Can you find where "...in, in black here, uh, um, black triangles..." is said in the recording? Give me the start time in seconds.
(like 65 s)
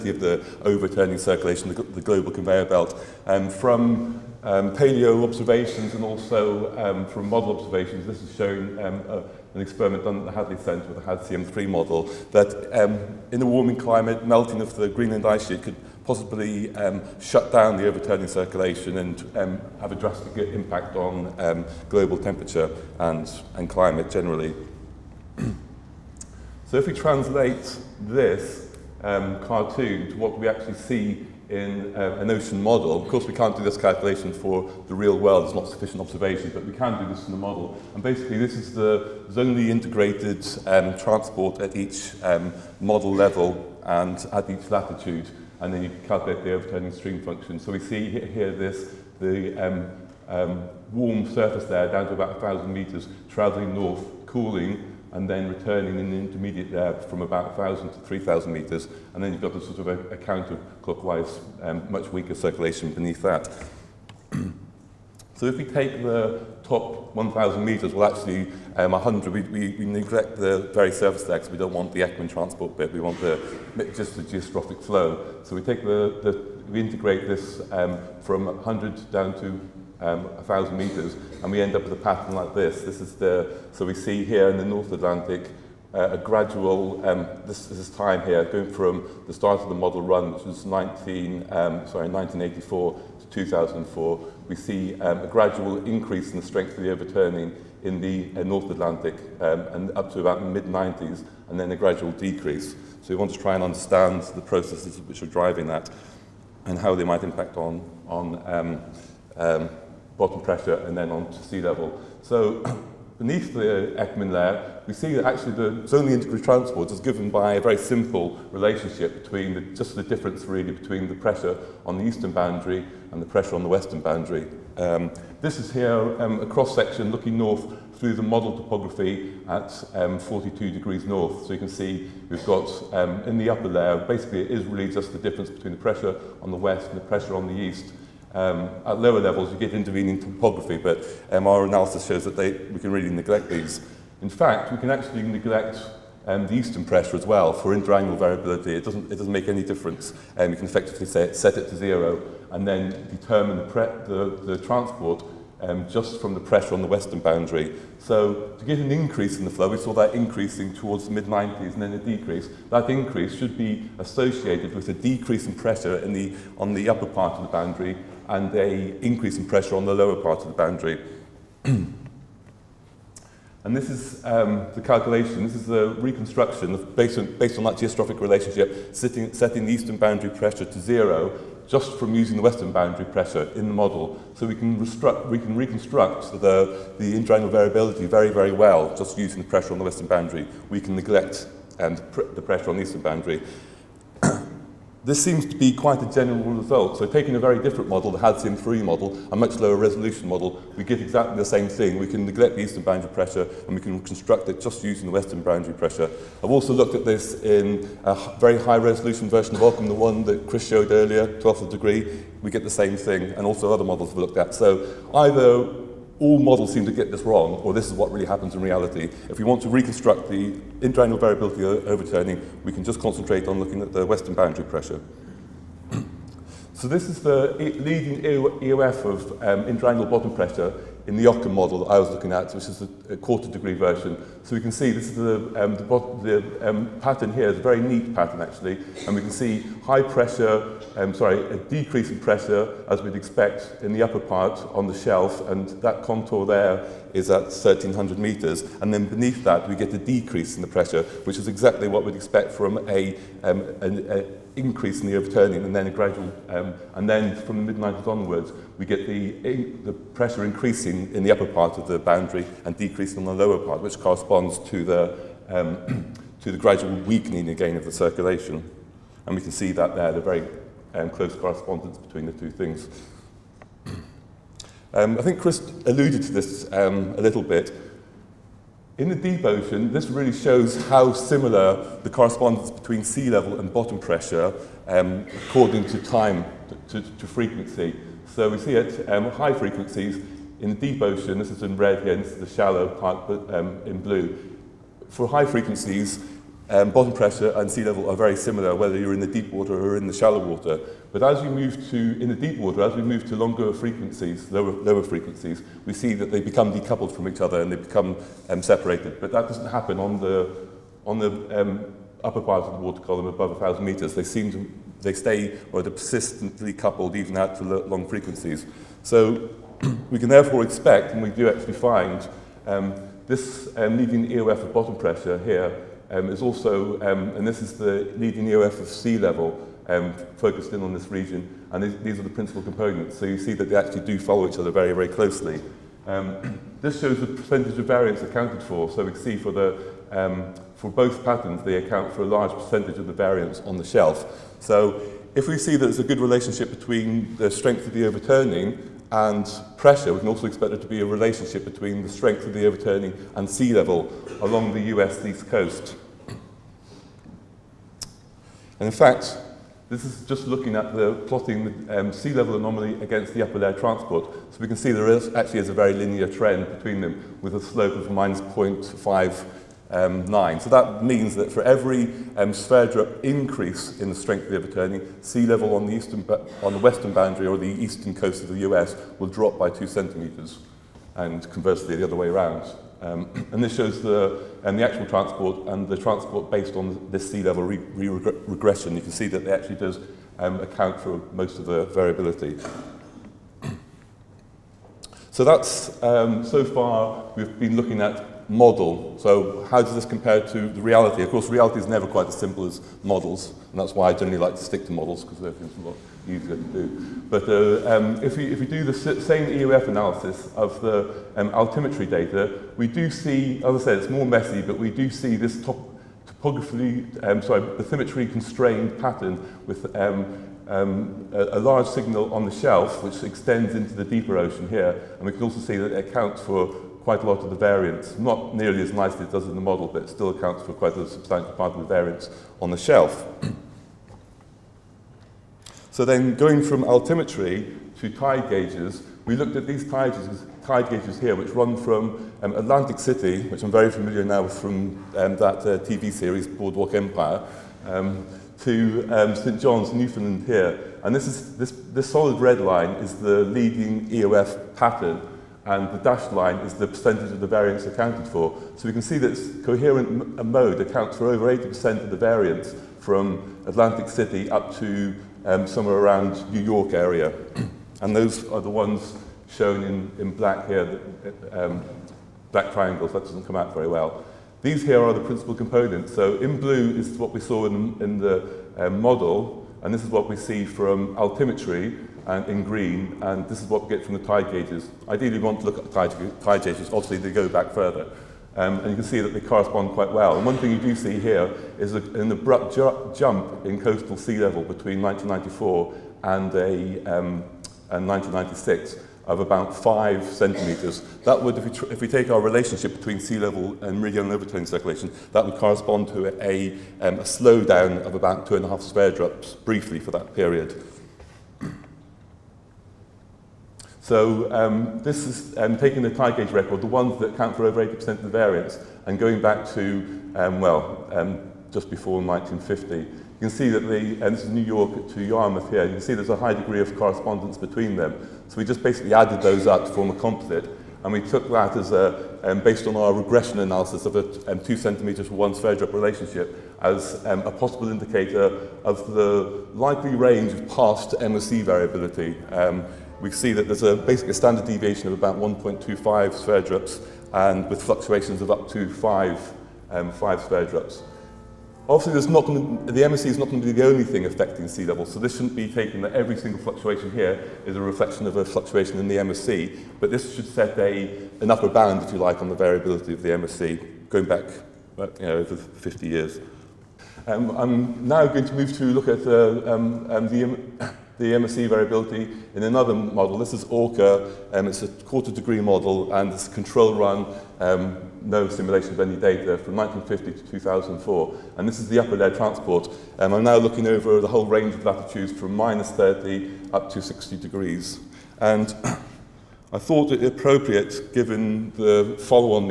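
469 s.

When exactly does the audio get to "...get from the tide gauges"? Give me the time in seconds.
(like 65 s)
483 s.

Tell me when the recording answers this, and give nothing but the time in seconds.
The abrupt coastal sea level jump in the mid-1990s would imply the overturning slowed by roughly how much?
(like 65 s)
508 s.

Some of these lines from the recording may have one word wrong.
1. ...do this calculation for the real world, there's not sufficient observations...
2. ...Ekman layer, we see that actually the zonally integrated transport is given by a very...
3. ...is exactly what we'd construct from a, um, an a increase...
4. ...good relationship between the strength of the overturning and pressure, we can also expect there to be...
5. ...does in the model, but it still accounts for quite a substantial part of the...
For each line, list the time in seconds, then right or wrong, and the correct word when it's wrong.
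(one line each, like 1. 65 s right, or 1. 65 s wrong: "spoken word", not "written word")
1. 33 s right
2. 113 s right
3. 251 s wrong: "expect", not "construct"
4. 346 s right
5. 429 s right.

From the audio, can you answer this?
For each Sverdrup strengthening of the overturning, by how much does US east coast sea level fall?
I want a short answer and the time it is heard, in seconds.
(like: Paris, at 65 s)
2 centimetres, at 379 s.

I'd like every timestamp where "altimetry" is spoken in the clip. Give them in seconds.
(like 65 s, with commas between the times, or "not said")
411 s, 436 s, 481 s.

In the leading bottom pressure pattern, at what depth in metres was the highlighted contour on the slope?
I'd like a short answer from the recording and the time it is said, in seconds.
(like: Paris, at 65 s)
1300 metres, at 247 s.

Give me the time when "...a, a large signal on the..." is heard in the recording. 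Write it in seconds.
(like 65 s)
421 s.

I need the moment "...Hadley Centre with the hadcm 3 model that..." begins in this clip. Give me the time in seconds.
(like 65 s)
10 s.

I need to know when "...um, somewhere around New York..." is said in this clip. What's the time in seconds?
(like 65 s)
465 s.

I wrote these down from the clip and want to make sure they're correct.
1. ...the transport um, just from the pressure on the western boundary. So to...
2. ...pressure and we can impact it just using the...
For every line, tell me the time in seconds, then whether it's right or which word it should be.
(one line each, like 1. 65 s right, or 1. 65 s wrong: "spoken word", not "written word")
1. 154 s right
2. 203 s wrong: "construct", not "impact".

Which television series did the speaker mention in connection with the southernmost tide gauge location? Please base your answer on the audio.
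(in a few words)
Boardwalk Empire.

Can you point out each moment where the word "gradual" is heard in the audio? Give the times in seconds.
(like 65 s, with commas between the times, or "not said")
86 s, 95 s, 101 s, 255 s, 266 s.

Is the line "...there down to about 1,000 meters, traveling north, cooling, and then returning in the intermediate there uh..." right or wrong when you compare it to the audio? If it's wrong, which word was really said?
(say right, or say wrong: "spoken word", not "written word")
right.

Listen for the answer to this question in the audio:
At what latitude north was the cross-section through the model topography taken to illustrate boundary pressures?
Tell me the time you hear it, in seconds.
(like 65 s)
130 s.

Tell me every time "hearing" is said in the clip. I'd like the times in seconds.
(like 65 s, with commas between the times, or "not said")
not said.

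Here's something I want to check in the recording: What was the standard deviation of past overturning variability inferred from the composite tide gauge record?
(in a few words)
1.25 Sverdrups.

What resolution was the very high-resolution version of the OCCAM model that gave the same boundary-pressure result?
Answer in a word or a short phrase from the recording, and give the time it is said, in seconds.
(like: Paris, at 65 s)
12th of a degree, at 211 s.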